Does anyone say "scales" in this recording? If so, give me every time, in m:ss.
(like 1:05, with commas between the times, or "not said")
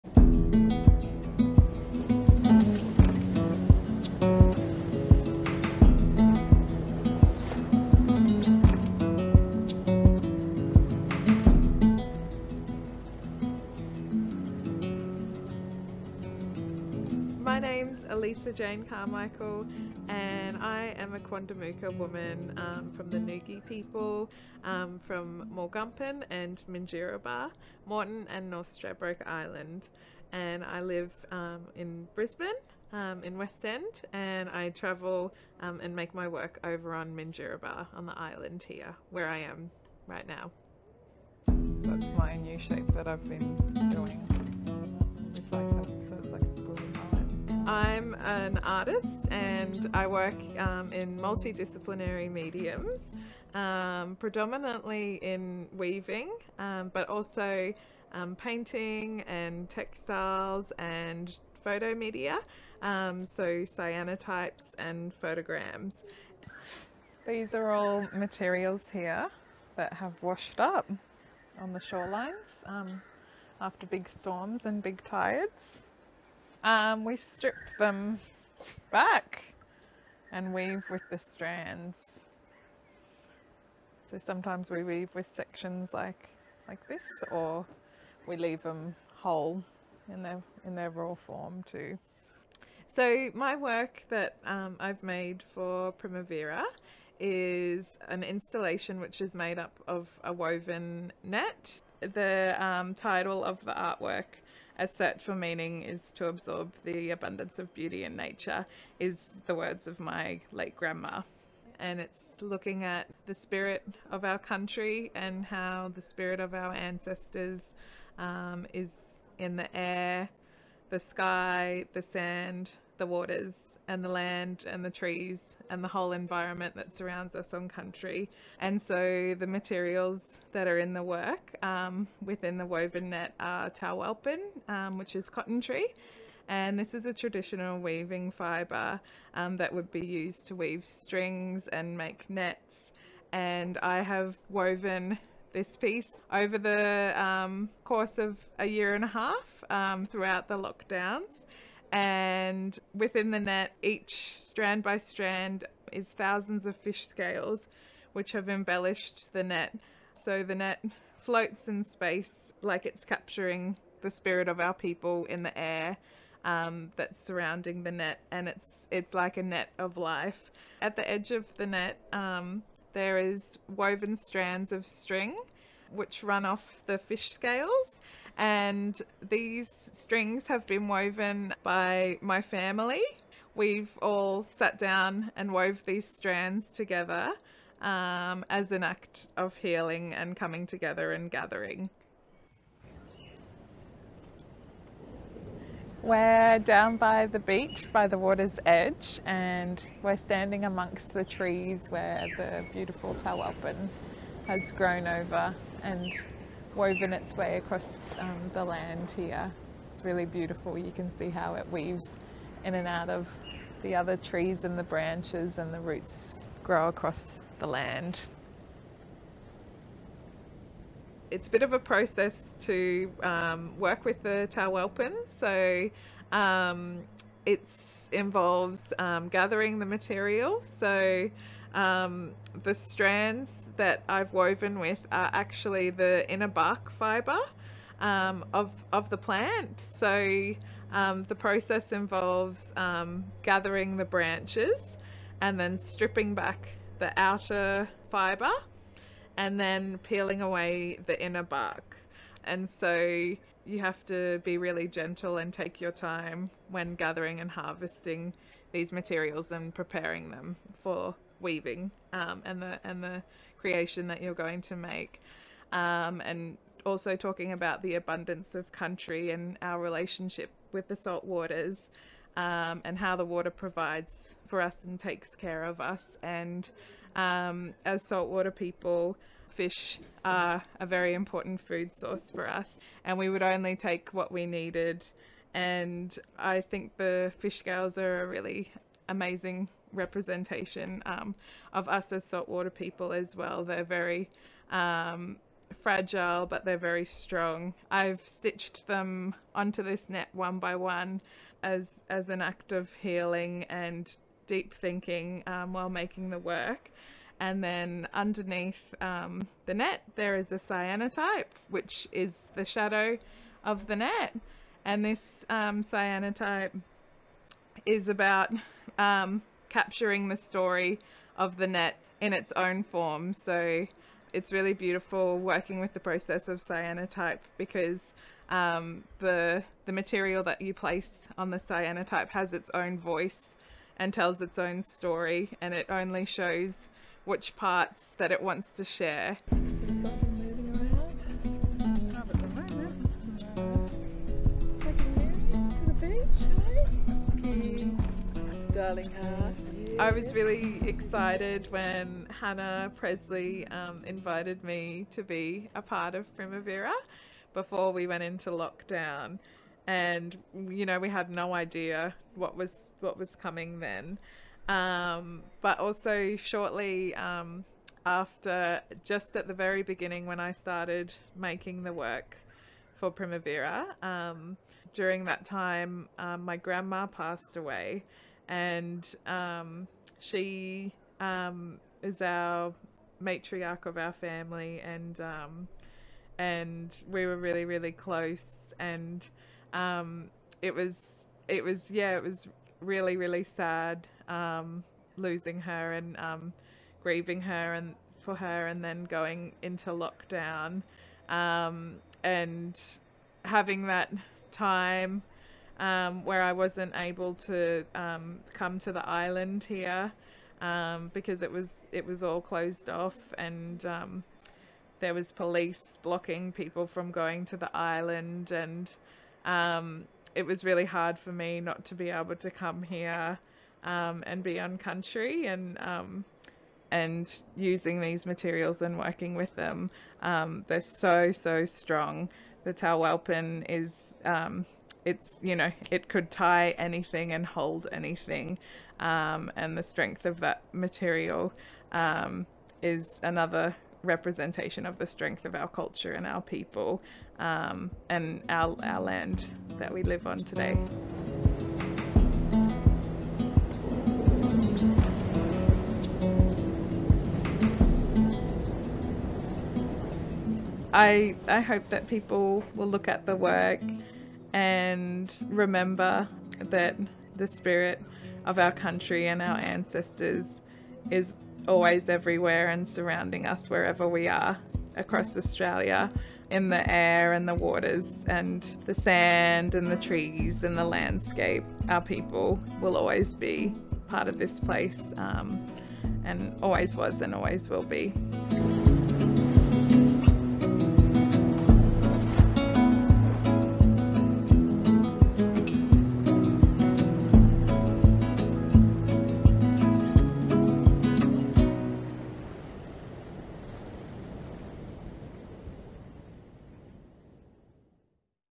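2:37, 2:57, 4:47.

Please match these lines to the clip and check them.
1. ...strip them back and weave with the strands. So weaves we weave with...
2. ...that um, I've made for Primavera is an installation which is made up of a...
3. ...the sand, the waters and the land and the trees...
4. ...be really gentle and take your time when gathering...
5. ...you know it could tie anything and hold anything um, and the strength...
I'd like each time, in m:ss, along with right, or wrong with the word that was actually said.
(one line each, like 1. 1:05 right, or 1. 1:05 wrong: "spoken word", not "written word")
1. 1:17 wrong: "sometimes", not "weaves"
2. 1:34 right
3. 2:01 right
4. 4:14 right
5. 7:15 right.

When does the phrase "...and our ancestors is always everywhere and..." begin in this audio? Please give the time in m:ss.
7:49.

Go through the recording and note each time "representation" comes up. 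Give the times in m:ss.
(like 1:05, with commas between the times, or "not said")
4:49, 7:24.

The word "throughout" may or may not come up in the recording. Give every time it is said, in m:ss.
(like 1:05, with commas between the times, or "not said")
2:30.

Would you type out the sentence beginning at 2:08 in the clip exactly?
And so the materials that are in the work um, within the woven net are talwalpin, um, which is cotton tree.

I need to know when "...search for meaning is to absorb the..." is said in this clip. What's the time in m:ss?
1:44.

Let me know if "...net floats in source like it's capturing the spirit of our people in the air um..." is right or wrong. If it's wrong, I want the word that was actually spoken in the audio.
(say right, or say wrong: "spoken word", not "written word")
wrong: "space", not "source".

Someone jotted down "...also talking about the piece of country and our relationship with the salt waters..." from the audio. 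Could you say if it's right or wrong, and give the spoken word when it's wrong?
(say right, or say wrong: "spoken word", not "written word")
wrong: "abundance", not "piece".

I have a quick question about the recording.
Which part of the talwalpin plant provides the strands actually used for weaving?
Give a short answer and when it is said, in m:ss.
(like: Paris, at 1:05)
Inner bark fibre, at 3:56.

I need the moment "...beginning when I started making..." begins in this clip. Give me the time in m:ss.
6:09.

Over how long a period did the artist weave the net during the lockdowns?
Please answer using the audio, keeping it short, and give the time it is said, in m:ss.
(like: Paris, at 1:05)
A year and a half, at 2:28.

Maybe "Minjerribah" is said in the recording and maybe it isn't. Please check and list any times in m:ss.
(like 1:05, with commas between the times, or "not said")
0:26, 0:37.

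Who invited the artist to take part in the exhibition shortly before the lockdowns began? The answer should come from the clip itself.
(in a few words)
Hannah Presley.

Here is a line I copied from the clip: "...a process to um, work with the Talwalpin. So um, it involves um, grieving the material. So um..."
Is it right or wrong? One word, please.
wrong.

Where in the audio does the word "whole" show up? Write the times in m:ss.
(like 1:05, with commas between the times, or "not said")
1:29, 2:05.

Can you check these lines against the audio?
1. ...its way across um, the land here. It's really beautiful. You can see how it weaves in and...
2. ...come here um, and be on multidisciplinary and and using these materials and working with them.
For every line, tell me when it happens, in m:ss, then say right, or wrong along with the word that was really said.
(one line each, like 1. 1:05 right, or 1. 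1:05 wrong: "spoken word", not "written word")
1. 3:27 right
2. 7:02 wrong: "country", not "multidisciplinary".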